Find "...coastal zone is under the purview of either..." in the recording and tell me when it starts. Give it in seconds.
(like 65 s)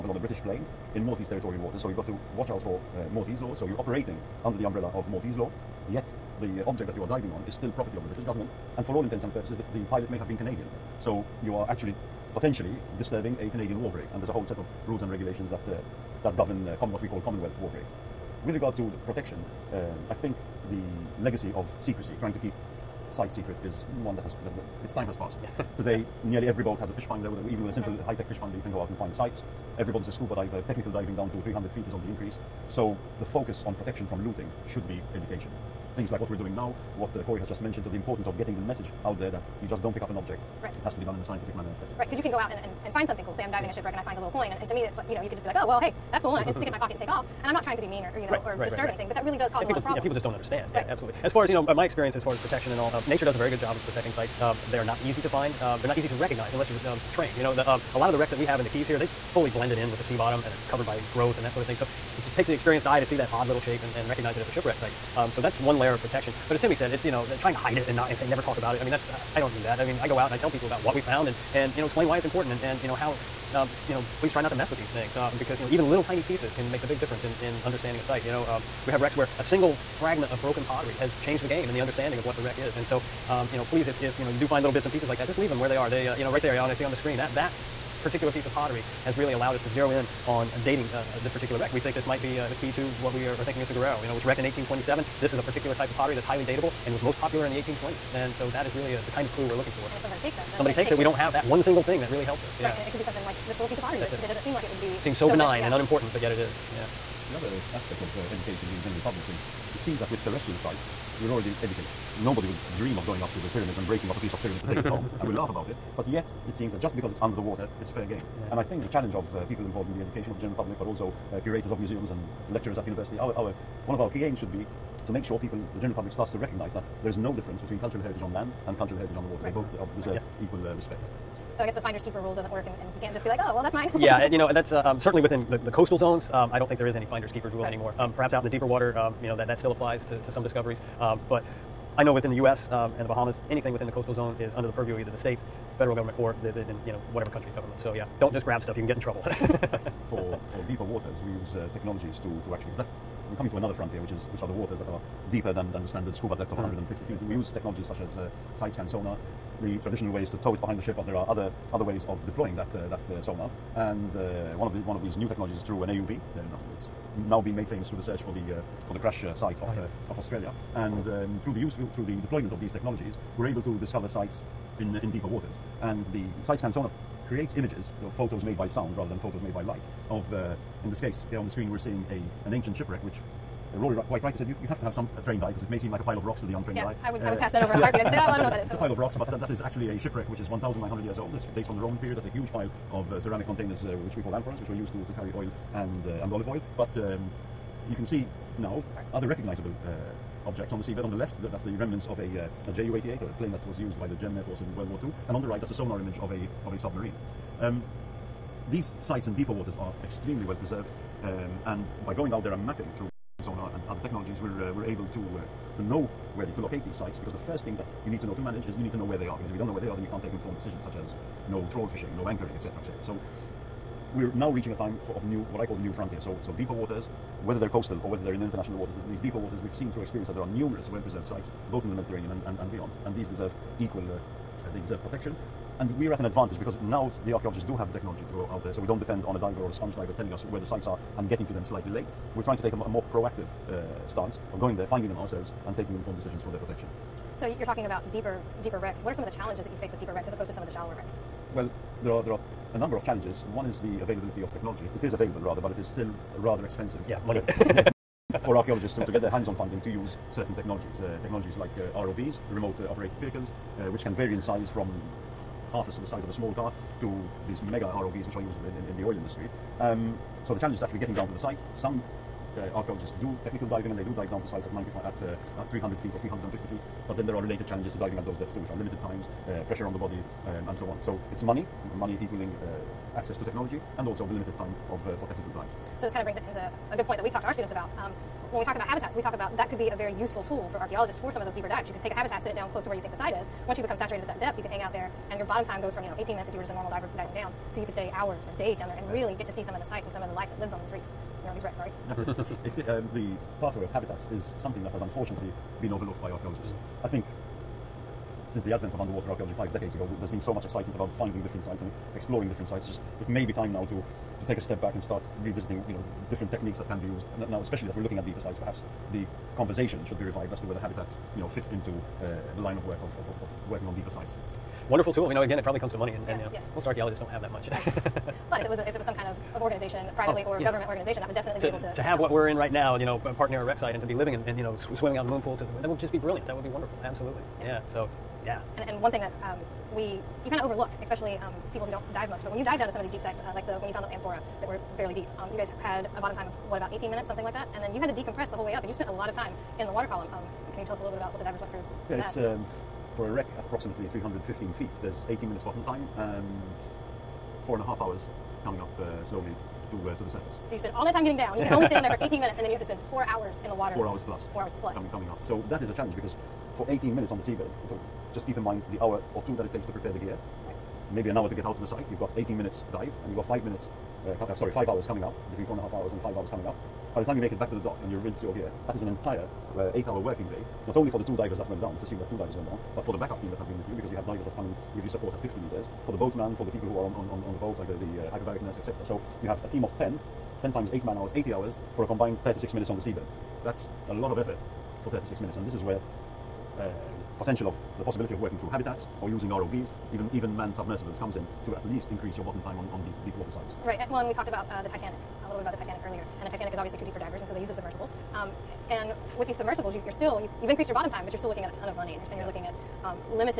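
143 s.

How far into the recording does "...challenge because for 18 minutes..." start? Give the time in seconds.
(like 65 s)
365 s.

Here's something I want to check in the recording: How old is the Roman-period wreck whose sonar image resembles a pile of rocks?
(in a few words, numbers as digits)
1,900 years.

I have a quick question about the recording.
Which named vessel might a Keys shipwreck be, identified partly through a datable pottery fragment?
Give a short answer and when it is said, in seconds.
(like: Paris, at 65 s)
Guerrero, at 93 s.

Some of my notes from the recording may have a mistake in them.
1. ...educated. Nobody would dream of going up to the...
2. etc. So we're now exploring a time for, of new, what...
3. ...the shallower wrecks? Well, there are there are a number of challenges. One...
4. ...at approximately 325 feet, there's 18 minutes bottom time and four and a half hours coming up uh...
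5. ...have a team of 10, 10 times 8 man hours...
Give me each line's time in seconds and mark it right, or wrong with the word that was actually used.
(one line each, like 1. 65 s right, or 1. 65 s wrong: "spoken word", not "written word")
1. 111 s right
2. 222 s wrong: "reaching", not "exploring"
3. 250 s right
4. 353 s wrong: "315", not "325"
5. 389 s right.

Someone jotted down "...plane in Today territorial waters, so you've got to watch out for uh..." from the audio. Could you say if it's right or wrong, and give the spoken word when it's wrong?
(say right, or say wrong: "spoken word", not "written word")
wrong: "Maltese", not "Today".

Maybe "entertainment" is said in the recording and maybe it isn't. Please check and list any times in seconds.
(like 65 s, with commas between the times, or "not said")
not said.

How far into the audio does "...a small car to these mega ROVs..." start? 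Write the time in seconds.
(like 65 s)
266 s.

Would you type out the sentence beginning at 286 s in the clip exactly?
So this kind of brings it into a good point that we've talked to our students about.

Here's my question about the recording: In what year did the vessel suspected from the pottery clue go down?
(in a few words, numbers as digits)
1827.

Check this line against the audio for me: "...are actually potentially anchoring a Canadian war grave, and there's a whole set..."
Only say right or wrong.
wrong.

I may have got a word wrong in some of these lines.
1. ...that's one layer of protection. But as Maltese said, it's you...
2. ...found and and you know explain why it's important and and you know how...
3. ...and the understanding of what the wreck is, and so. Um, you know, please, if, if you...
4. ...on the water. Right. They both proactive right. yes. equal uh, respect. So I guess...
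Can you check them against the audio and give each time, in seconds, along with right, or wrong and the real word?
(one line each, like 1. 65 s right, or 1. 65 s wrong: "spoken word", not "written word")
1. 65 s wrong: "Timmy", not "Maltese"
2. 71 s right
3. 81 s right
4. 129 s wrong: "deserve", not "proactive".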